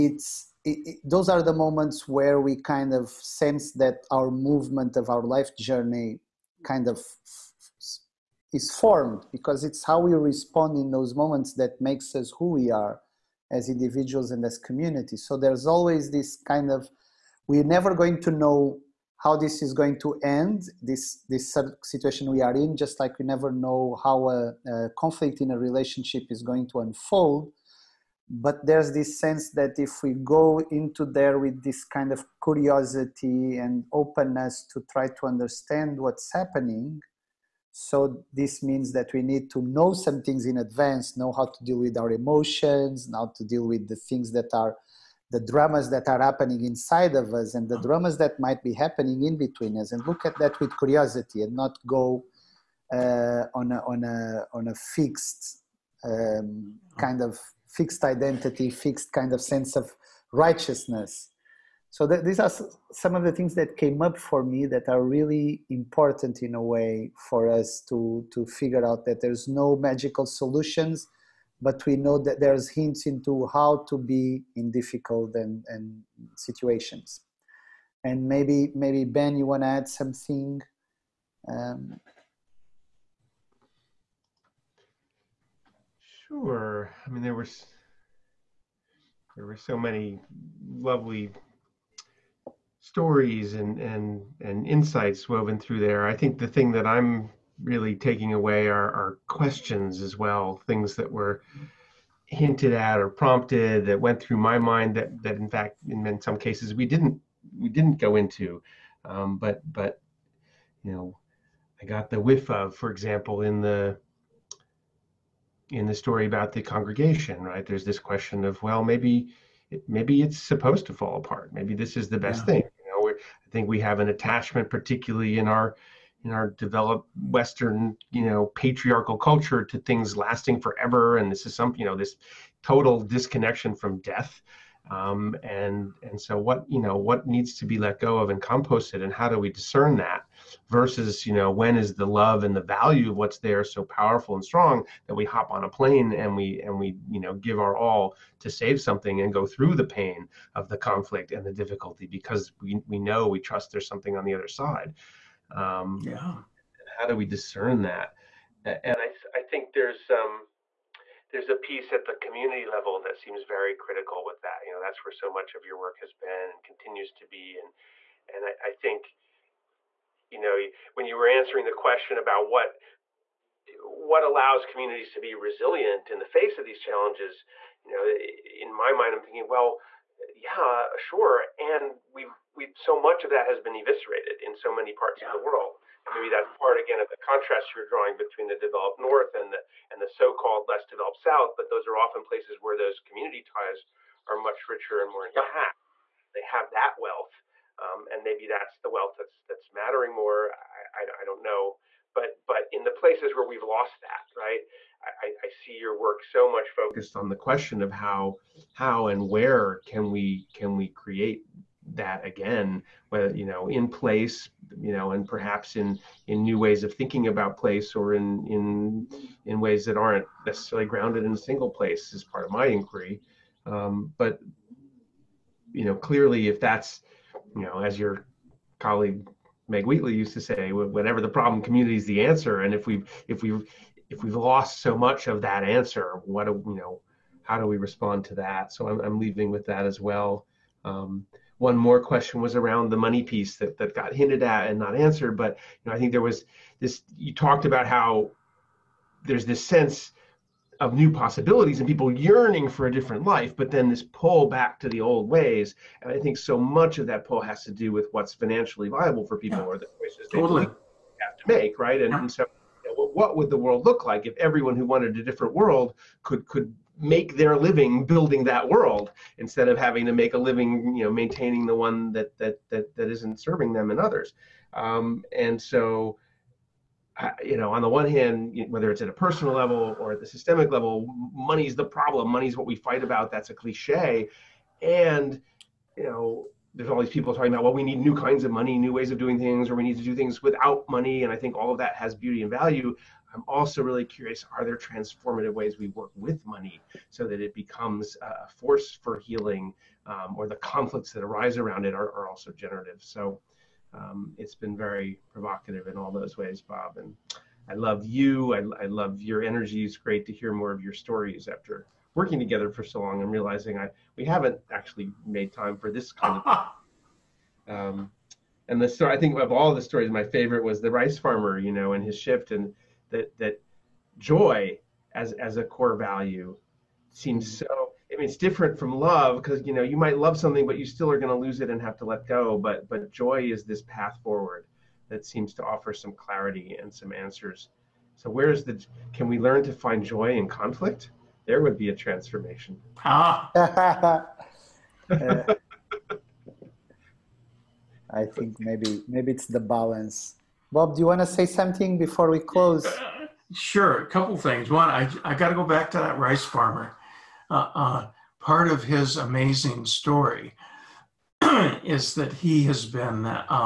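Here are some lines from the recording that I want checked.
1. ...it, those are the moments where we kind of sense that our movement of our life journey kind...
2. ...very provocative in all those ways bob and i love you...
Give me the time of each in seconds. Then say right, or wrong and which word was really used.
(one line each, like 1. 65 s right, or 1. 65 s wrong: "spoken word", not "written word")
1. 0 s right
2. 304 s right.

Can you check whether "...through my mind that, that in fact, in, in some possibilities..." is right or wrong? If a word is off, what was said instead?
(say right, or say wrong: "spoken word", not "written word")
wrong: "cases", not "possibilities".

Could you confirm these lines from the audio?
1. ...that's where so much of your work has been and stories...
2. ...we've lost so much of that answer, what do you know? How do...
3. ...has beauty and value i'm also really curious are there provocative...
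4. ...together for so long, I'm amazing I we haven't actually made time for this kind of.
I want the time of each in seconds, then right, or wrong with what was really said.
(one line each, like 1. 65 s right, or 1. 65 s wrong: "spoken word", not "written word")
1. 164 s wrong: "continues", not "stories"
2. 234 s right
3. 291 s wrong: "transformative", not "provocative"
4. 312 s wrong: "realizing", not "amazing".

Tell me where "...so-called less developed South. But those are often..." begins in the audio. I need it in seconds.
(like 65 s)
190 s.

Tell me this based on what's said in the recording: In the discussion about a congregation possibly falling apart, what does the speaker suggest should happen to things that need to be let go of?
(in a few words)
composted.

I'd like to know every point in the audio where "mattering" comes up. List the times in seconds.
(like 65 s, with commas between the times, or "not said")
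199 s.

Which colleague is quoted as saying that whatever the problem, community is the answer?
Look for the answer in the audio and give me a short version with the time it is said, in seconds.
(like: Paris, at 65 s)
Meg Wheatley, at 229 s.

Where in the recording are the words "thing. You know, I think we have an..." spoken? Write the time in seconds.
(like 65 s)
122 s.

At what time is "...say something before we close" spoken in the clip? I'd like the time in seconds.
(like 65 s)
351 s.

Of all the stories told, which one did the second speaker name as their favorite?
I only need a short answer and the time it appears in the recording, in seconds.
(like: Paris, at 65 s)
the rice farmer, at 320 s.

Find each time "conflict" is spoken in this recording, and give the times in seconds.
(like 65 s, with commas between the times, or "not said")
24 s, 150 s, 300 s, 340 s.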